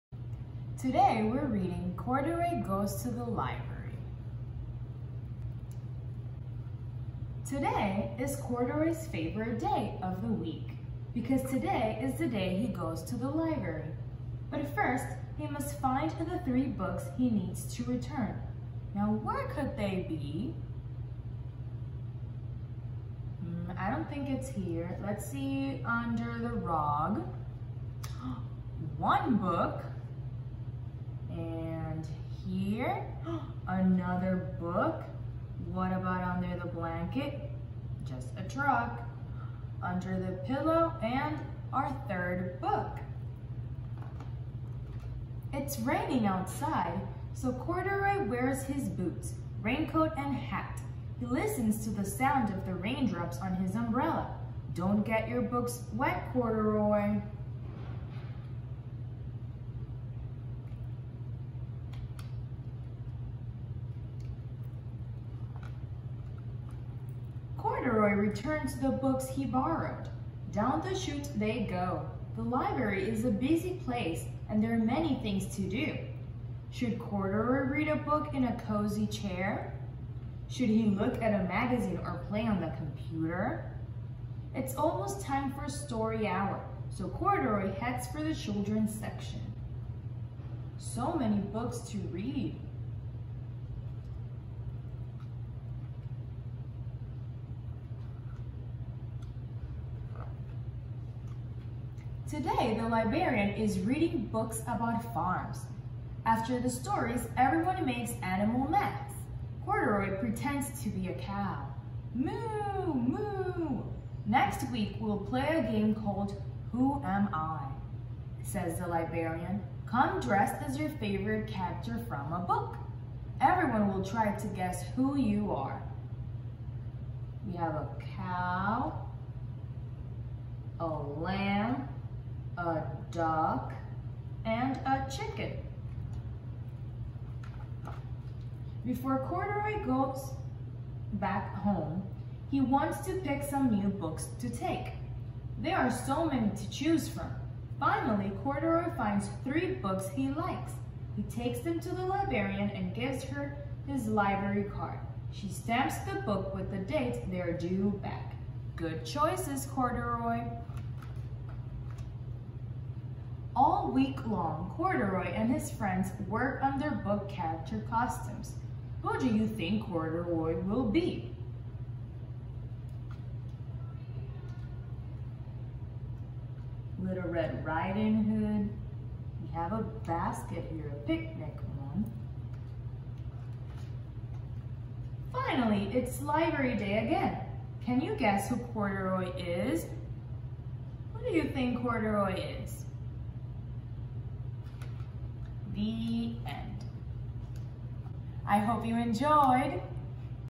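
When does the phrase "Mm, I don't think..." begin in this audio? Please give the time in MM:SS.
00:23.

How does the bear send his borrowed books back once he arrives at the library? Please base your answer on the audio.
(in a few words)
Down the chute.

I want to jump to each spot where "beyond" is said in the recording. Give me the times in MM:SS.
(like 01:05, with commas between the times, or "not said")
not said.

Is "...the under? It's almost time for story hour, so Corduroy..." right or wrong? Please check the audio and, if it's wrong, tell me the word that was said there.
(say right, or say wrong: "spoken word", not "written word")
wrong: "computer", not "under".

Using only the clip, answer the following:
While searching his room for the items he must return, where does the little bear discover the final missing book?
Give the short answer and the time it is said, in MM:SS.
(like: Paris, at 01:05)
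Under the pillow, at 00:39.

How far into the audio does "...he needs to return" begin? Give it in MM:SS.
00:17.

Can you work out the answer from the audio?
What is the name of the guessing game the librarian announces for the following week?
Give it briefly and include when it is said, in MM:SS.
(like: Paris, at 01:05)
Who Am I?, at 01:56.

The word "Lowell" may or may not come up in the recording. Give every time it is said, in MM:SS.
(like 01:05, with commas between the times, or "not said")
not said.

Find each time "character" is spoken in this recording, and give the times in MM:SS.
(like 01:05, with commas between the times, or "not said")
02:01, 02:47.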